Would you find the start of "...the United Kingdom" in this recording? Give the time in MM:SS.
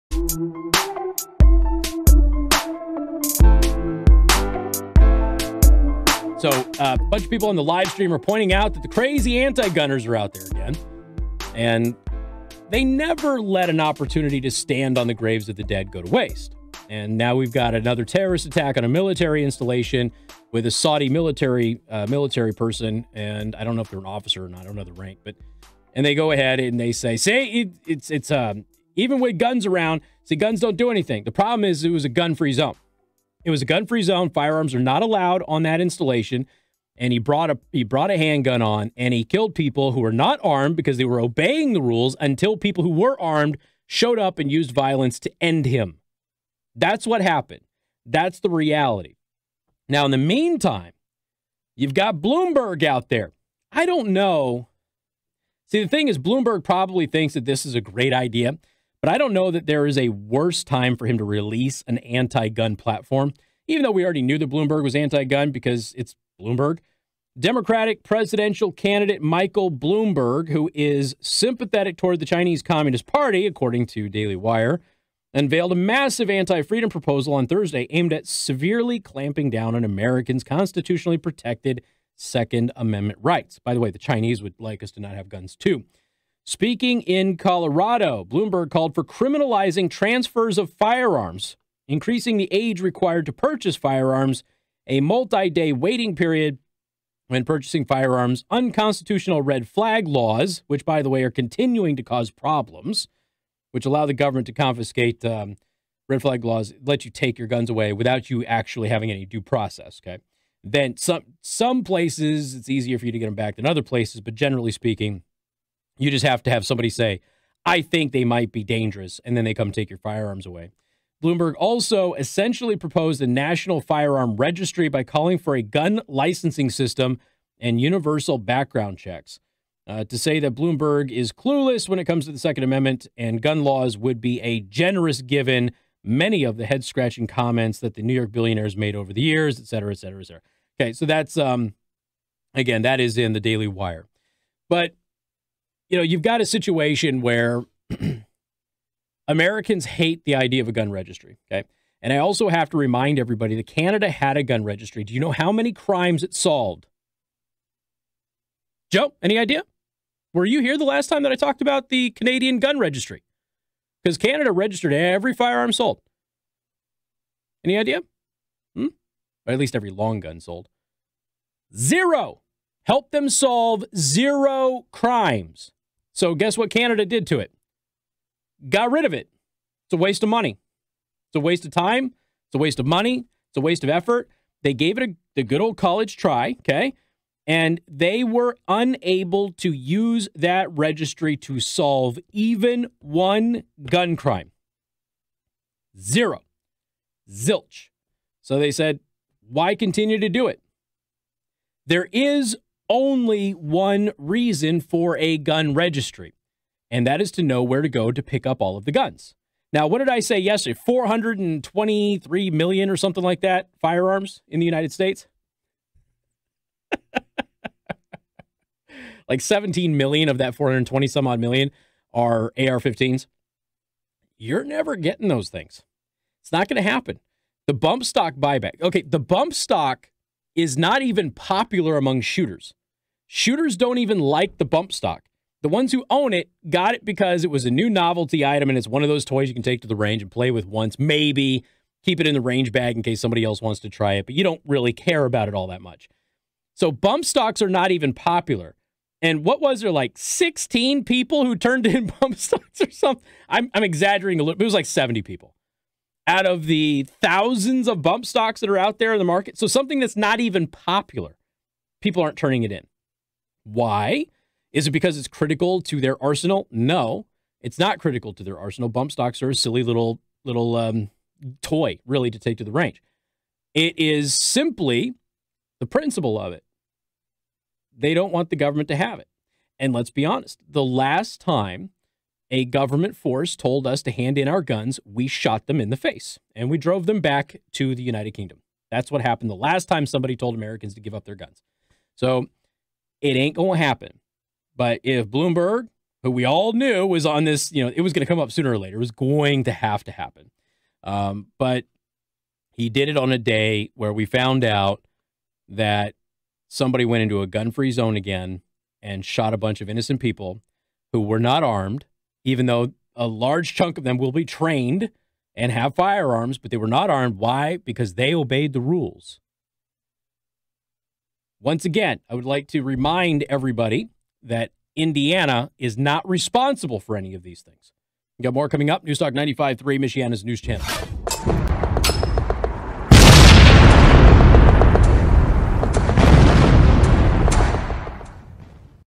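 04:47.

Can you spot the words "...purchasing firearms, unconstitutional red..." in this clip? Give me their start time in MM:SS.
01:37.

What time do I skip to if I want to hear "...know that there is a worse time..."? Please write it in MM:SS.
00:59.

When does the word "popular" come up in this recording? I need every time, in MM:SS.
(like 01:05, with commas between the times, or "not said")
03:51, 04:08, 04:20.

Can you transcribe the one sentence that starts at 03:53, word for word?
Shooters don't even like the bump stock.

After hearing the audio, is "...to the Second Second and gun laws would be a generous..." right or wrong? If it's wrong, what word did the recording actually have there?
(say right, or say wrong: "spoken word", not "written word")
wrong: "Amendment", not "Second".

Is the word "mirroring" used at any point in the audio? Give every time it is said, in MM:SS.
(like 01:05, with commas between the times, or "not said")
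not said.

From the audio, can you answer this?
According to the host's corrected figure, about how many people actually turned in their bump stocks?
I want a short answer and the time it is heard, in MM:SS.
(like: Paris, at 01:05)
70, at 04:14.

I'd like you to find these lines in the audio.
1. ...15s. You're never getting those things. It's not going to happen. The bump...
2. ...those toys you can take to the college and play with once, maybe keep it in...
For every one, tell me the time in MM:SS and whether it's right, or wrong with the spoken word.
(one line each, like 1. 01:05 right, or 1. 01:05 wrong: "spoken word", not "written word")
1. 03:42 right
2. 03:59 wrong: "range", not "college".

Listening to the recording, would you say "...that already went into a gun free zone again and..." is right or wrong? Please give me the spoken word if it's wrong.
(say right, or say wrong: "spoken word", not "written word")
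wrong: "somebody", not "already".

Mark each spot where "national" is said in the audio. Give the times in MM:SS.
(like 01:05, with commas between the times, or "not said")
02:03.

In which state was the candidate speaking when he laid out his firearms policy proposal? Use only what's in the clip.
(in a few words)
Colorado.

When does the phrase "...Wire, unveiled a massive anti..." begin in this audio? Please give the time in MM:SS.
01:14.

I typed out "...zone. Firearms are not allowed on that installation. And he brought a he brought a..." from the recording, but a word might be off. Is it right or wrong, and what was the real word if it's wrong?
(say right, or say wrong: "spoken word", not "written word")
right.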